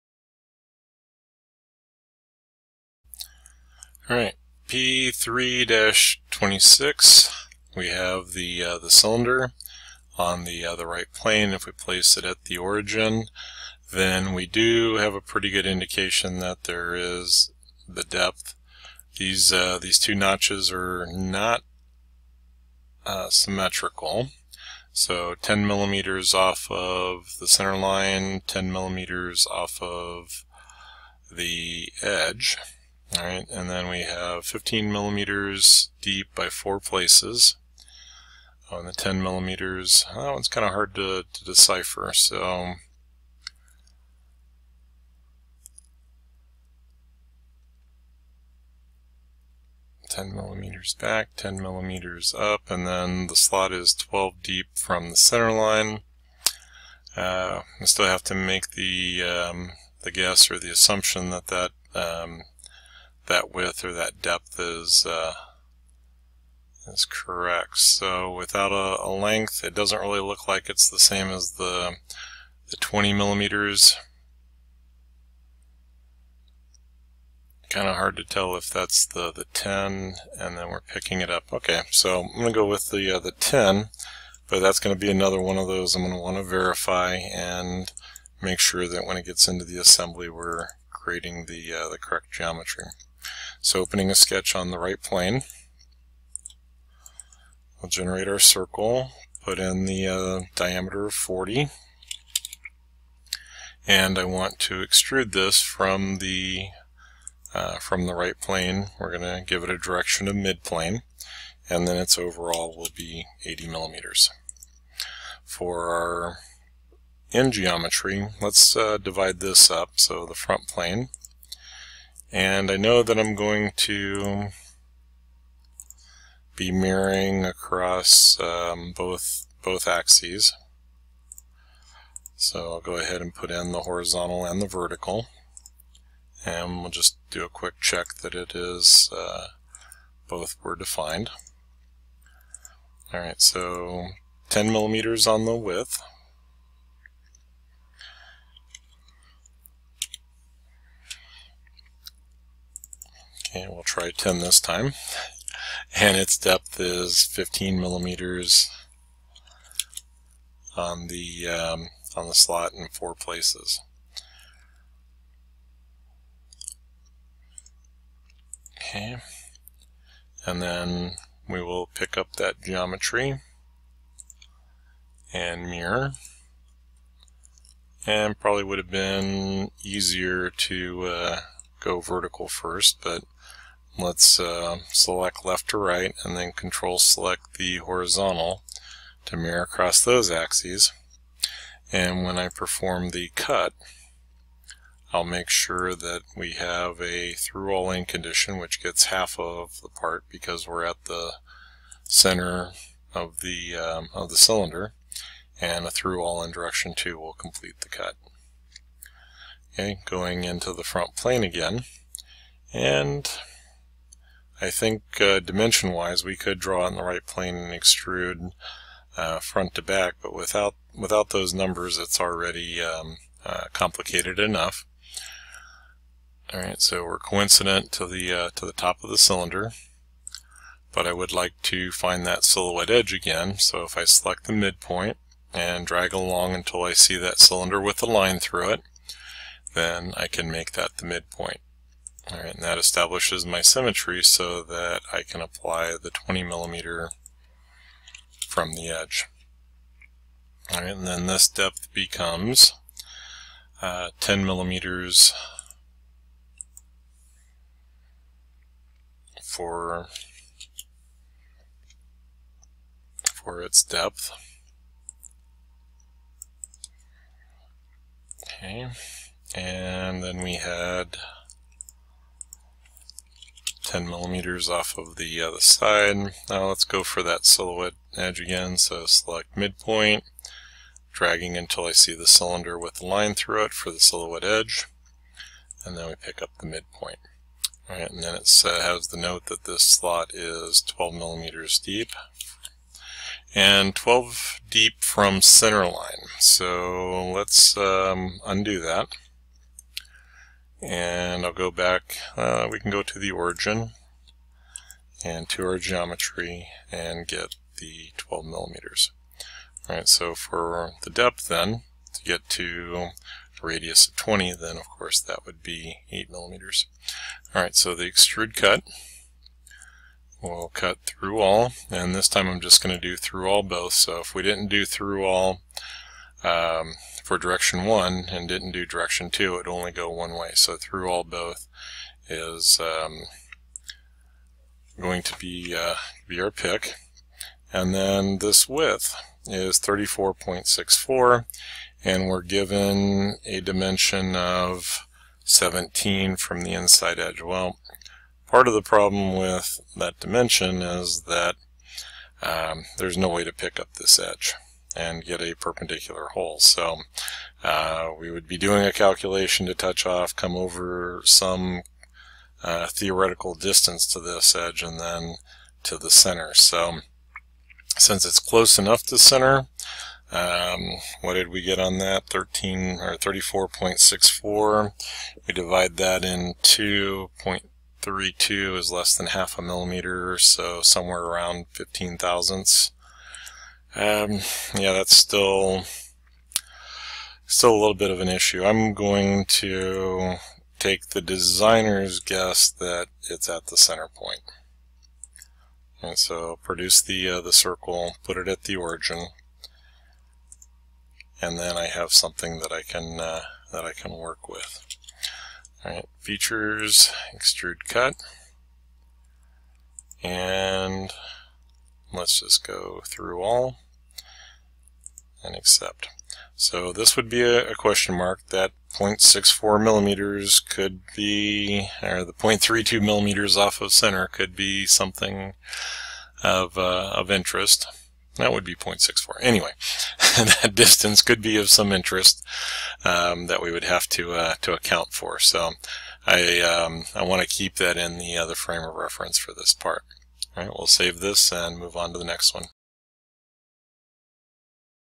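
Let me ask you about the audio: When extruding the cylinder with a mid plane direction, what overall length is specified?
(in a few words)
80 millimeters.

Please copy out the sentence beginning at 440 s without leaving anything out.
All right, we'll save this and move on to the next one.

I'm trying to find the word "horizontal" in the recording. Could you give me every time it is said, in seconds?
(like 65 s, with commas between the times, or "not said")
133 s, 187 s.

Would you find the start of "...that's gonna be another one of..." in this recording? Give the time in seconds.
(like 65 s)
84 s.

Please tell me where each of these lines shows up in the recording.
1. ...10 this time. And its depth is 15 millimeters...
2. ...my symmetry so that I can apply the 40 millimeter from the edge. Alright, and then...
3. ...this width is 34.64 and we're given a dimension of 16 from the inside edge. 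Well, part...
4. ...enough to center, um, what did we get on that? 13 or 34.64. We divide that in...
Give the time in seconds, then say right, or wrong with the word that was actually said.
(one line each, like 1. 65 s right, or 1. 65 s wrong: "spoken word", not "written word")
1. 154 s right
2. 243 s wrong: "20", not "40"
3. 338 s wrong: "17", not "16"
4. 368 s right.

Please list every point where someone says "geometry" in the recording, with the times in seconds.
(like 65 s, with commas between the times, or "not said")
92 s, 117 s, 172 s, 305 s.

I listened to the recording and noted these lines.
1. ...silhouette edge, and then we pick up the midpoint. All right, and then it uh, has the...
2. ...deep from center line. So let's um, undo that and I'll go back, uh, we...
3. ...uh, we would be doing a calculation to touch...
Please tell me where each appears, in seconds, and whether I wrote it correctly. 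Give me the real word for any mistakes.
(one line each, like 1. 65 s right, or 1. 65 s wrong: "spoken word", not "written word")
1. 283 s right
2. 294 s right
3. 357 s right.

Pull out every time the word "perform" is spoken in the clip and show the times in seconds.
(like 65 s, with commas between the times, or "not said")
192 s.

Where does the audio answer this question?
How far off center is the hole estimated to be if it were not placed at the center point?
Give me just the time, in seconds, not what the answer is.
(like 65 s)
422 s.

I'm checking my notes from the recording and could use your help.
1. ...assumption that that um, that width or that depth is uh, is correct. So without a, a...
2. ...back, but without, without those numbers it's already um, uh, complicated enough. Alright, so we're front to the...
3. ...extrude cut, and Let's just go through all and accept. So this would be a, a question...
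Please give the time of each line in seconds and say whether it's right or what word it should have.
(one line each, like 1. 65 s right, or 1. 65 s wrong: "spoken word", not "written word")
1. 60 s right
2. 219 s wrong: "coincident", not "front"
3. 407 s right.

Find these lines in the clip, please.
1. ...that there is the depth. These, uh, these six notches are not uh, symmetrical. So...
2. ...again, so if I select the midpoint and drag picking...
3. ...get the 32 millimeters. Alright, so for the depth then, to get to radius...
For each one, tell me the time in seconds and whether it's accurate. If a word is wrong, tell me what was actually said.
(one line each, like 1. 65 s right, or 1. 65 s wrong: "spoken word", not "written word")
1. 16 s wrong: "two", not "six"
2. 233 s wrong: "along", not "picking"
3. 307 s wrong: "12", not "32".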